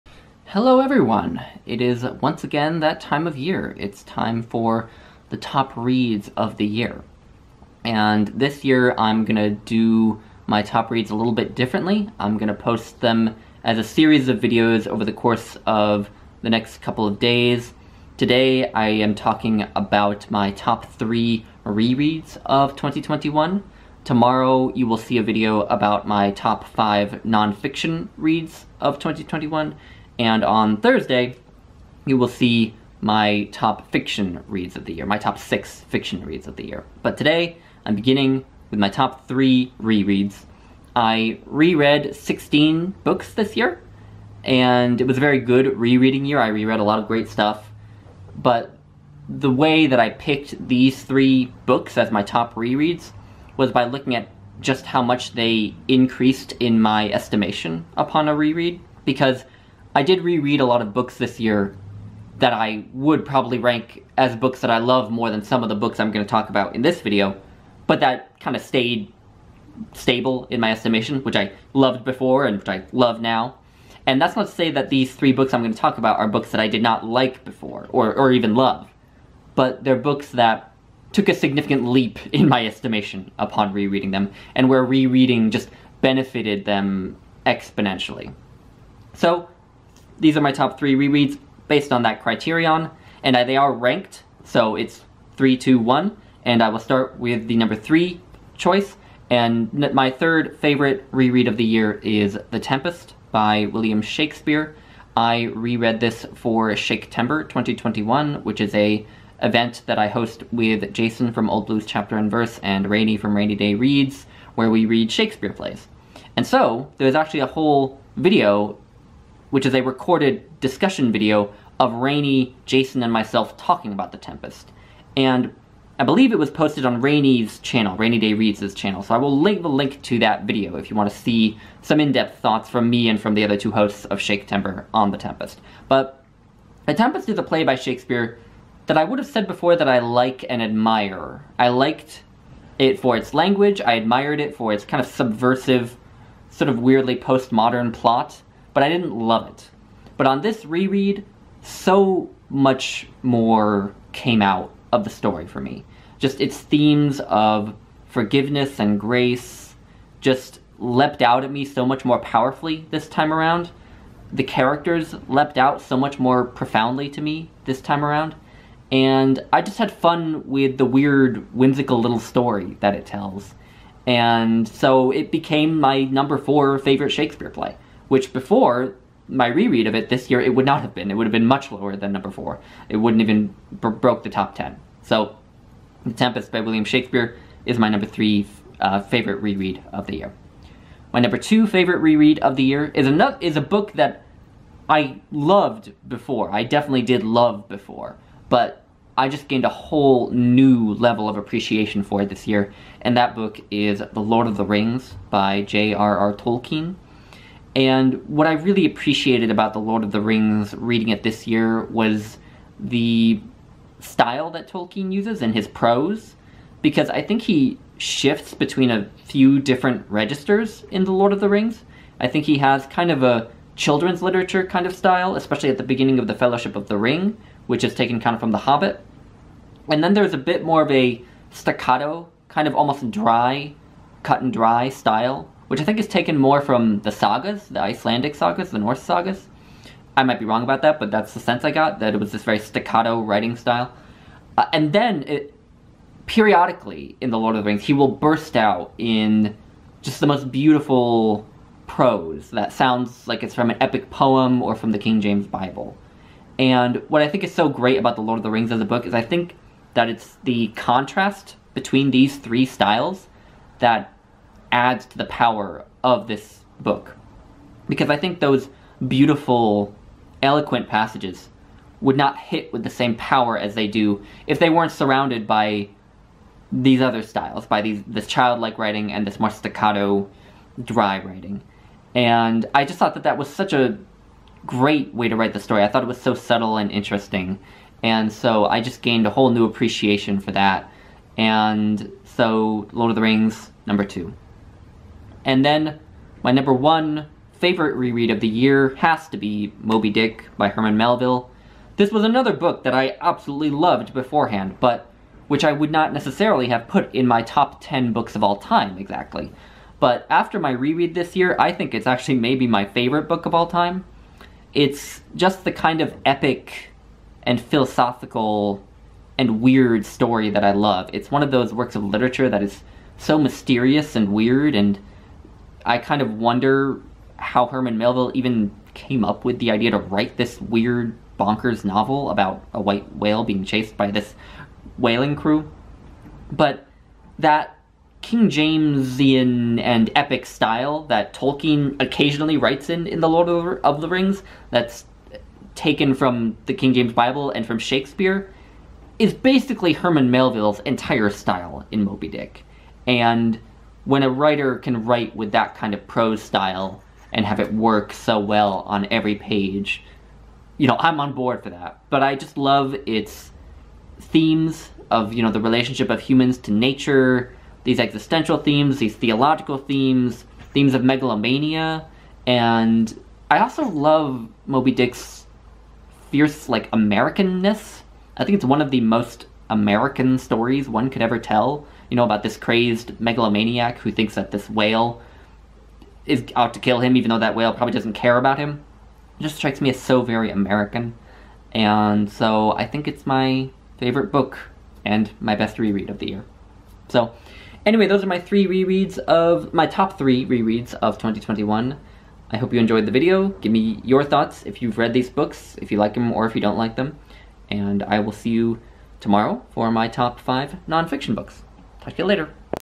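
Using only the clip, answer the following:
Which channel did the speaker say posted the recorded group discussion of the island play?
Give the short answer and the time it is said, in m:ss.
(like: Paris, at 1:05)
Rainy Day Reads, at 2:07.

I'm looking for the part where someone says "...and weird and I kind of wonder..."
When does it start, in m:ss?
5:24.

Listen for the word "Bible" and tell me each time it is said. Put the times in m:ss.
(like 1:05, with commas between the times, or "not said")
4:15, 5:47.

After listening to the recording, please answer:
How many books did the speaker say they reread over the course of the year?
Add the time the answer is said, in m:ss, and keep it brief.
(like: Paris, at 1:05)
16, at 0:42.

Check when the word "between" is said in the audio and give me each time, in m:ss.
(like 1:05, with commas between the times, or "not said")
3:38, 4:21.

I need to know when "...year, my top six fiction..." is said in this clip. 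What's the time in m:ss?
0:34.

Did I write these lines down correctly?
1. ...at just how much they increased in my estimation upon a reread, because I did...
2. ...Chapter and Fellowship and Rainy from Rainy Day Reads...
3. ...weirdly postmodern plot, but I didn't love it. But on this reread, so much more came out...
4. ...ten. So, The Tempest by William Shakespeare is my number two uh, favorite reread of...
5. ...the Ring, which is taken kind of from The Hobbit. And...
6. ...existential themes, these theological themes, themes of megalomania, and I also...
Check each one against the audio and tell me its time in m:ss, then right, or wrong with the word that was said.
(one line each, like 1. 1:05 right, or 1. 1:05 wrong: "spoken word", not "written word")
1. 0:54 right
2. 1:51 wrong: "Verse", not "Fellowship"
3. 2:26 right
4. 3:04 wrong: "three", not "two"
5. 3:46 right
6. 6:07 right.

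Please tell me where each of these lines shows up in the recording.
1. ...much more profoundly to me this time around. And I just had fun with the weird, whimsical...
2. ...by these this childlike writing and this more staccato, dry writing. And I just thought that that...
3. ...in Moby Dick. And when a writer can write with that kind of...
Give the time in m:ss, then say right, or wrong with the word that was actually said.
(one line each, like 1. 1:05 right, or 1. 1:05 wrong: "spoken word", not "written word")
1. 2:45 right
2. 4:37 right
3. 5:51 right.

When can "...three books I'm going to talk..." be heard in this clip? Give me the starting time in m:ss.
1:15.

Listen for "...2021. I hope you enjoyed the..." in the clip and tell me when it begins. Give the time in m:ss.
6:41.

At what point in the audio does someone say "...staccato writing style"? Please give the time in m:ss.
4:02.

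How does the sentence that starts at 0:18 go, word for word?
Today I am talking about my top three rereads of 2021.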